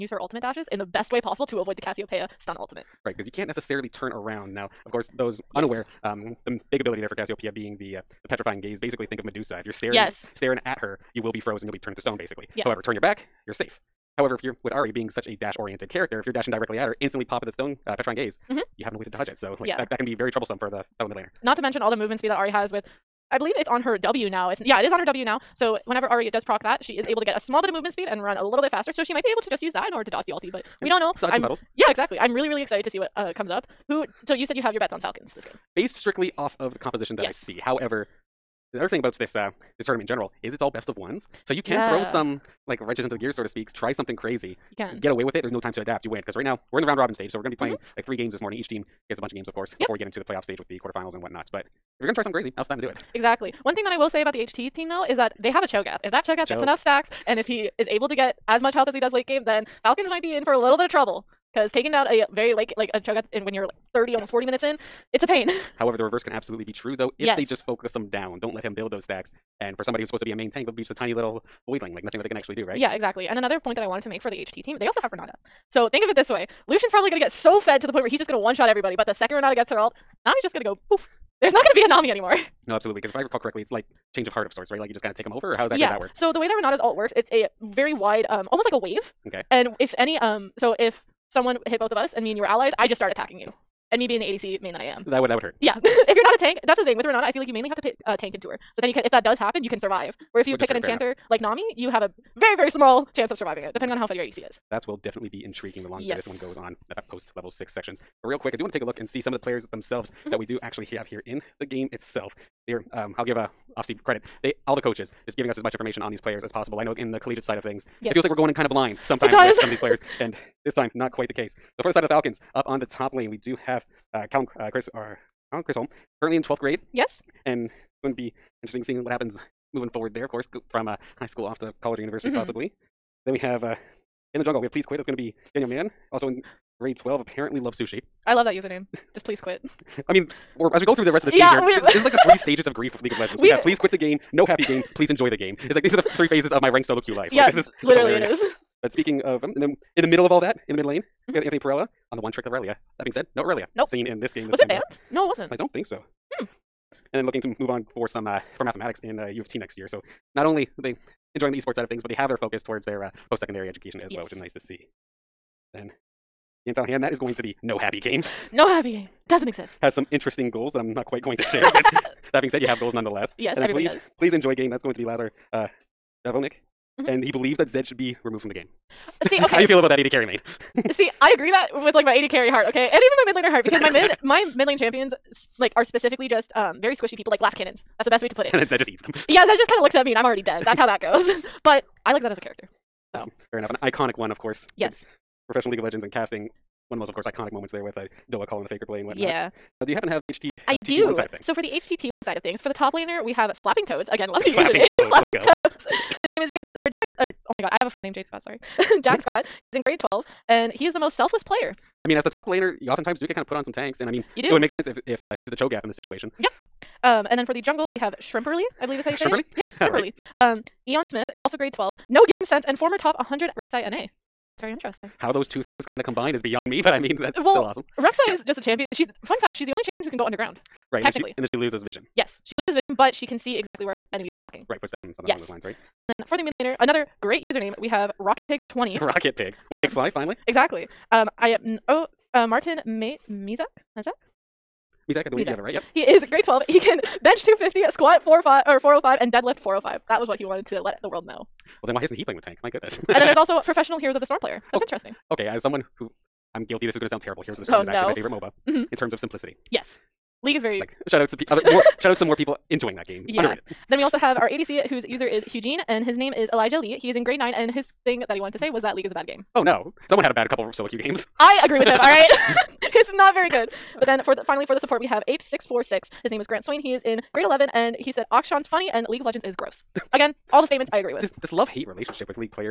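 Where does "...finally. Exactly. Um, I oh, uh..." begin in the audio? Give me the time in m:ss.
4:00.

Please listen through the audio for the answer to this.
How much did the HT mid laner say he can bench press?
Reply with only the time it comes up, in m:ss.
4:07.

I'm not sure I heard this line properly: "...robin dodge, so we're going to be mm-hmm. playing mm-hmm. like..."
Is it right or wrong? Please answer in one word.
wrong.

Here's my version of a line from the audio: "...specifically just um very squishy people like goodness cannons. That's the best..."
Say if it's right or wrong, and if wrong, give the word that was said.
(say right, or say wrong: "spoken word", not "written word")
wrong: "glass", not "goodness".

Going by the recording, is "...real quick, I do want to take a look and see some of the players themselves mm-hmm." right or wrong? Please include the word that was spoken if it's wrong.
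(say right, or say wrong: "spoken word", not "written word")
right.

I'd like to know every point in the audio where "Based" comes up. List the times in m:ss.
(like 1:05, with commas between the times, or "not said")
0:35.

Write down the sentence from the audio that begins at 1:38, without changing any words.
So then you can, if that does happen, you can survive.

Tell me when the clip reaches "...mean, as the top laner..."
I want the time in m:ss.
3:32.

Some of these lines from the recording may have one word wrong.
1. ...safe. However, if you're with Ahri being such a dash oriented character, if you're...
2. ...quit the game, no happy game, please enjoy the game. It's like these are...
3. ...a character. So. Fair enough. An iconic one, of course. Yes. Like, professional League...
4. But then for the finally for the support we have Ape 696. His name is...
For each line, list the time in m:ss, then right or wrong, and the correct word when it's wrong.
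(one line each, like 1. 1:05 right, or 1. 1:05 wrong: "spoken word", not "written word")
1. 0:13 right
2. 2:23 right
3. 3:12 right
4. 4:34 wrong: "646", not "696".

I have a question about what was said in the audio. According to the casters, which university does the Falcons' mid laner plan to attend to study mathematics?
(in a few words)
U of T.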